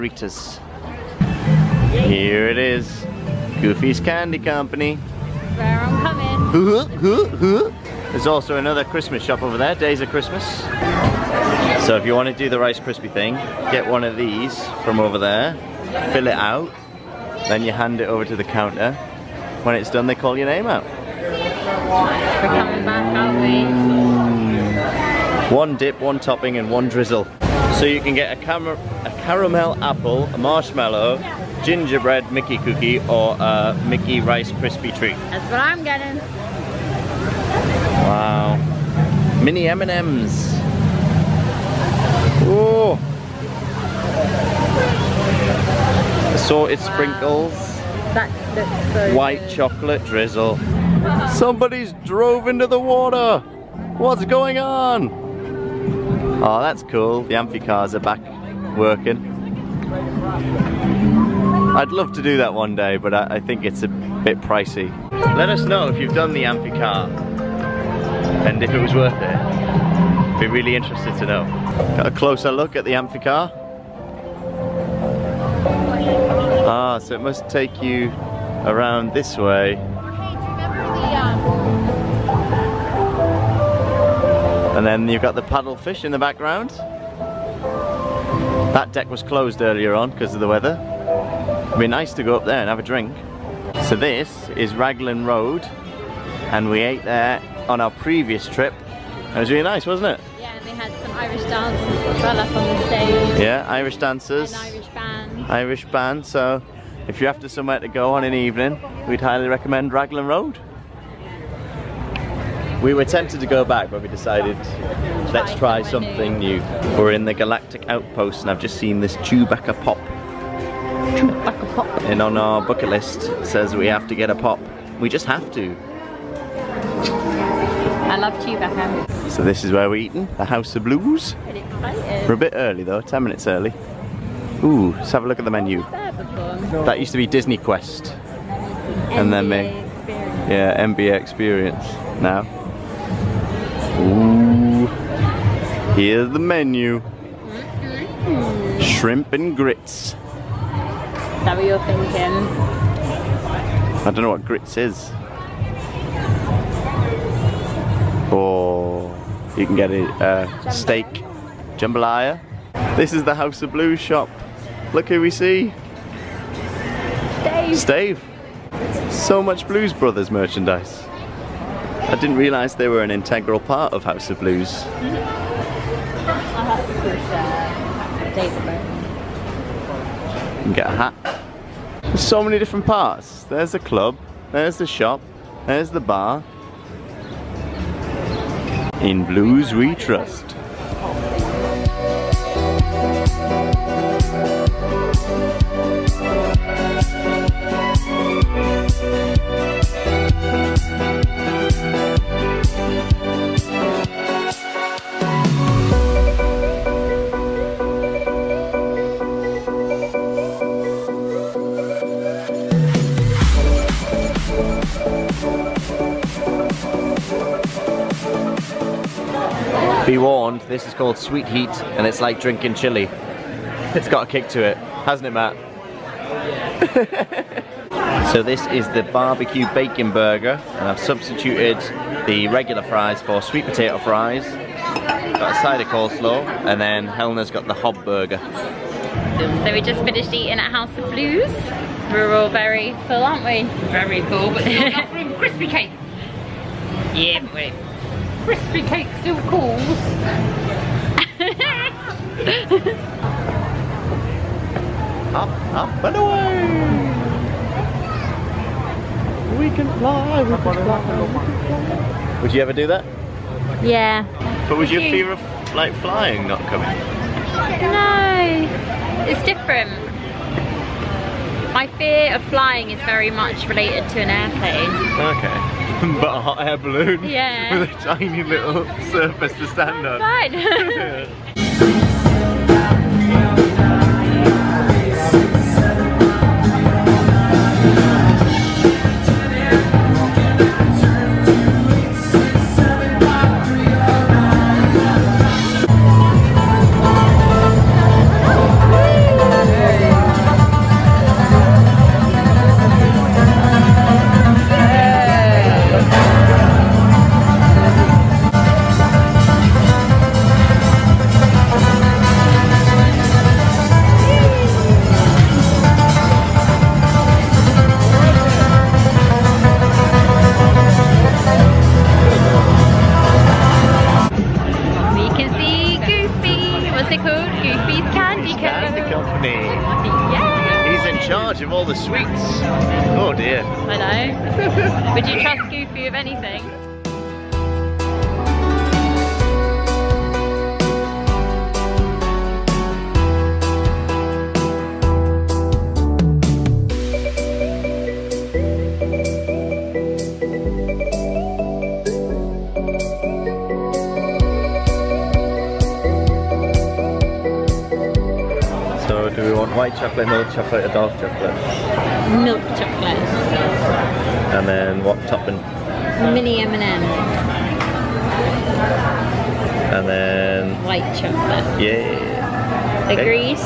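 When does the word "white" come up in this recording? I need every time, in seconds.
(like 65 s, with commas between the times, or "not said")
49 s, 359 s, 370 s.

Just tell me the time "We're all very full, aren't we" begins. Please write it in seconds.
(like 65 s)
242 s.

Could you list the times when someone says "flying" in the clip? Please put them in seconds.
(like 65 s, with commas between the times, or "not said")
265 s, 272 s.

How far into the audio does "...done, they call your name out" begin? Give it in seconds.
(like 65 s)
19 s.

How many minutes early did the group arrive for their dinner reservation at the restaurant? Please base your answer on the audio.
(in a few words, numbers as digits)
10.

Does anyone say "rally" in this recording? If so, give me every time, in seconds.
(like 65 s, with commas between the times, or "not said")
not said.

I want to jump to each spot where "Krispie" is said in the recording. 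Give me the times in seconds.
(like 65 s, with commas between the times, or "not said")
12 s, 34 s.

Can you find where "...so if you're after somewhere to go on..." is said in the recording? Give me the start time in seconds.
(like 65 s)
106 s.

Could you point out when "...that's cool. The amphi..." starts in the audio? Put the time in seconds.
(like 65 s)
56 s.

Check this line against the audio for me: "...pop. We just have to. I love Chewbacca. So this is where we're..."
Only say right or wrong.
right.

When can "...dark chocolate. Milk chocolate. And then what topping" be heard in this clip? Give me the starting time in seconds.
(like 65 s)
360 s.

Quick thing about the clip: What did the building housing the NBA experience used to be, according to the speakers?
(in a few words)
Disney Quest.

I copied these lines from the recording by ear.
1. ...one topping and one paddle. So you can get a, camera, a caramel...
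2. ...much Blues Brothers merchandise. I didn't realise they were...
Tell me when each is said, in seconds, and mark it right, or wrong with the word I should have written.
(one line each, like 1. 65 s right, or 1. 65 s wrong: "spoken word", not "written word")
1. 26 s wrong: "drizzle", not "paddle"
2. 169 s right.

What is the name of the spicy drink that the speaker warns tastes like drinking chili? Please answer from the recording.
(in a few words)
Sweet Heat.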